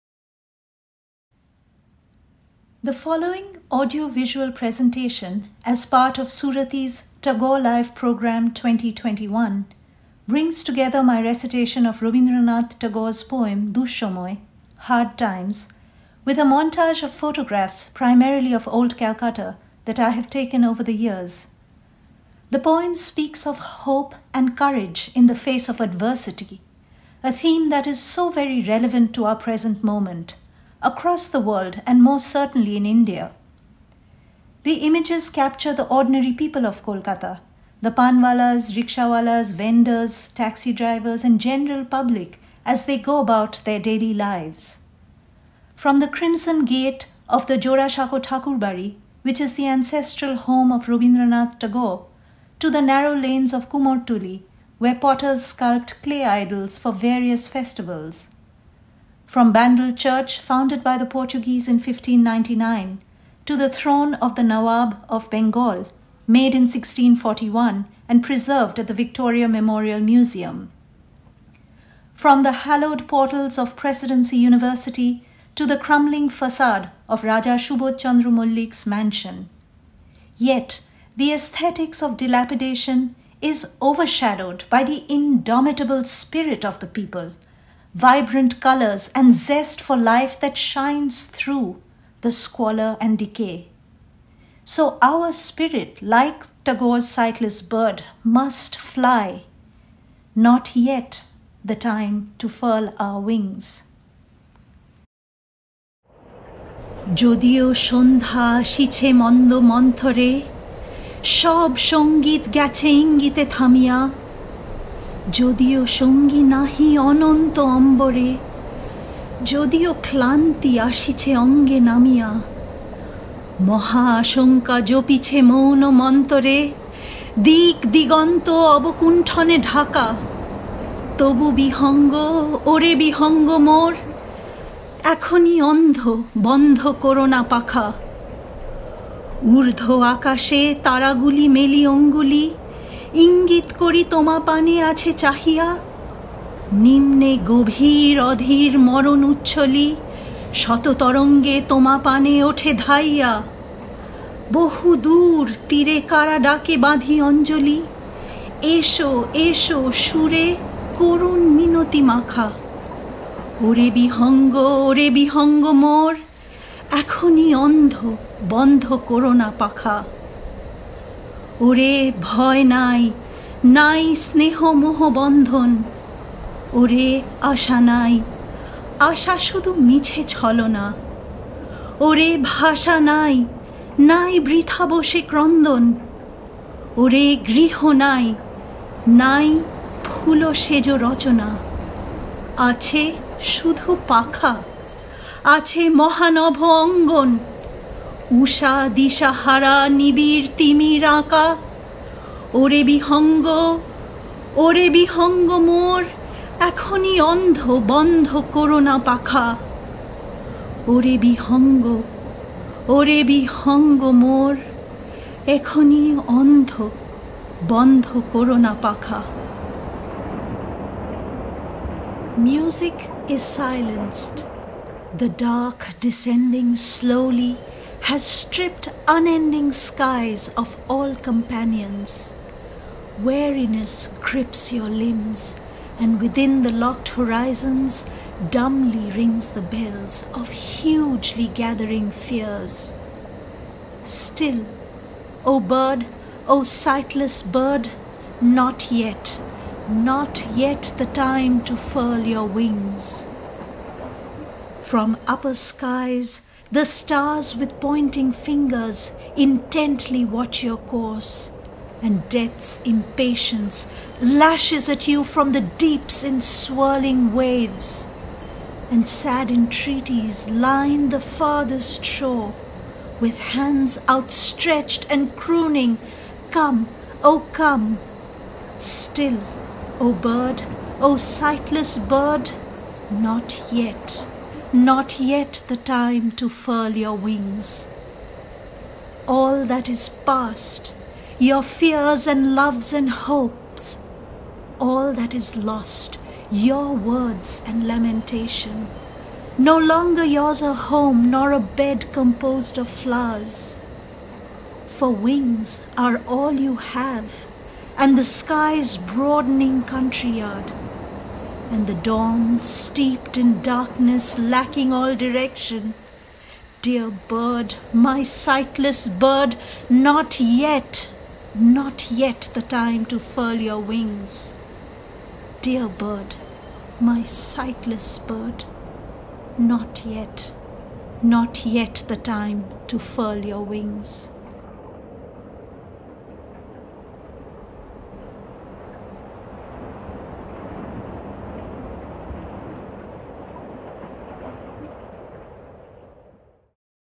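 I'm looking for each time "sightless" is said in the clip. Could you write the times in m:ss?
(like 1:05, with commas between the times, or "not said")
1:37, 4:06, 4:41, 5:18, 5:27.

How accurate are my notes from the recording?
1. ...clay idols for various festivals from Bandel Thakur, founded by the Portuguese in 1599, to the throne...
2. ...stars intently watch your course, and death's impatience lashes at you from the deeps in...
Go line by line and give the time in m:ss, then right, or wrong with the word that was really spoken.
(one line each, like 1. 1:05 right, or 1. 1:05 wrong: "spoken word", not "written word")
1. 0:56 wrong: "Church", not "Thakur"
2. 4:18 wrong: "fingers", not "stars".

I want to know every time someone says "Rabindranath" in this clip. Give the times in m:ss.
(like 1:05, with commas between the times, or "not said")
0:12, 0:50.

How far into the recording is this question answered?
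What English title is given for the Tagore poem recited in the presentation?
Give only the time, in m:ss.
0:14.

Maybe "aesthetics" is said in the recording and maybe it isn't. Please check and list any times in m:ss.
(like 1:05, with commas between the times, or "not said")
1:21.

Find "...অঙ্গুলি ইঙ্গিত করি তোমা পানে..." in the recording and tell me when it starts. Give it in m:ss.
2:21.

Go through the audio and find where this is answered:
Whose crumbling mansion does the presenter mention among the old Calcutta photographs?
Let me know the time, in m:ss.
1:17.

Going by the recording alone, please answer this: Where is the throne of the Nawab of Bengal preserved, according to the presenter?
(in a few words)
Victoria Memorial Museum.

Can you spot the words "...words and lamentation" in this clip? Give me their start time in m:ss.
4:56.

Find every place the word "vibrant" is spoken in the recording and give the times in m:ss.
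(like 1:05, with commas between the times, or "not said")
1:27.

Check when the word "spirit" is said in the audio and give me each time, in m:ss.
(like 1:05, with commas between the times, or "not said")
1:26, 1:35.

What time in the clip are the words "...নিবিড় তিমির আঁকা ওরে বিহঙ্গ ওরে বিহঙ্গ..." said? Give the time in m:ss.
3:19.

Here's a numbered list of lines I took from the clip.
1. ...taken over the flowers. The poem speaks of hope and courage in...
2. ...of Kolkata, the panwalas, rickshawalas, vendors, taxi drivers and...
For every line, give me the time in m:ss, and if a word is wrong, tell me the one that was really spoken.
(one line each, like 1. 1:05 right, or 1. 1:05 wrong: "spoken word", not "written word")
1. 0:20 wrong: "years", not "flowers"
2. 0:36 right.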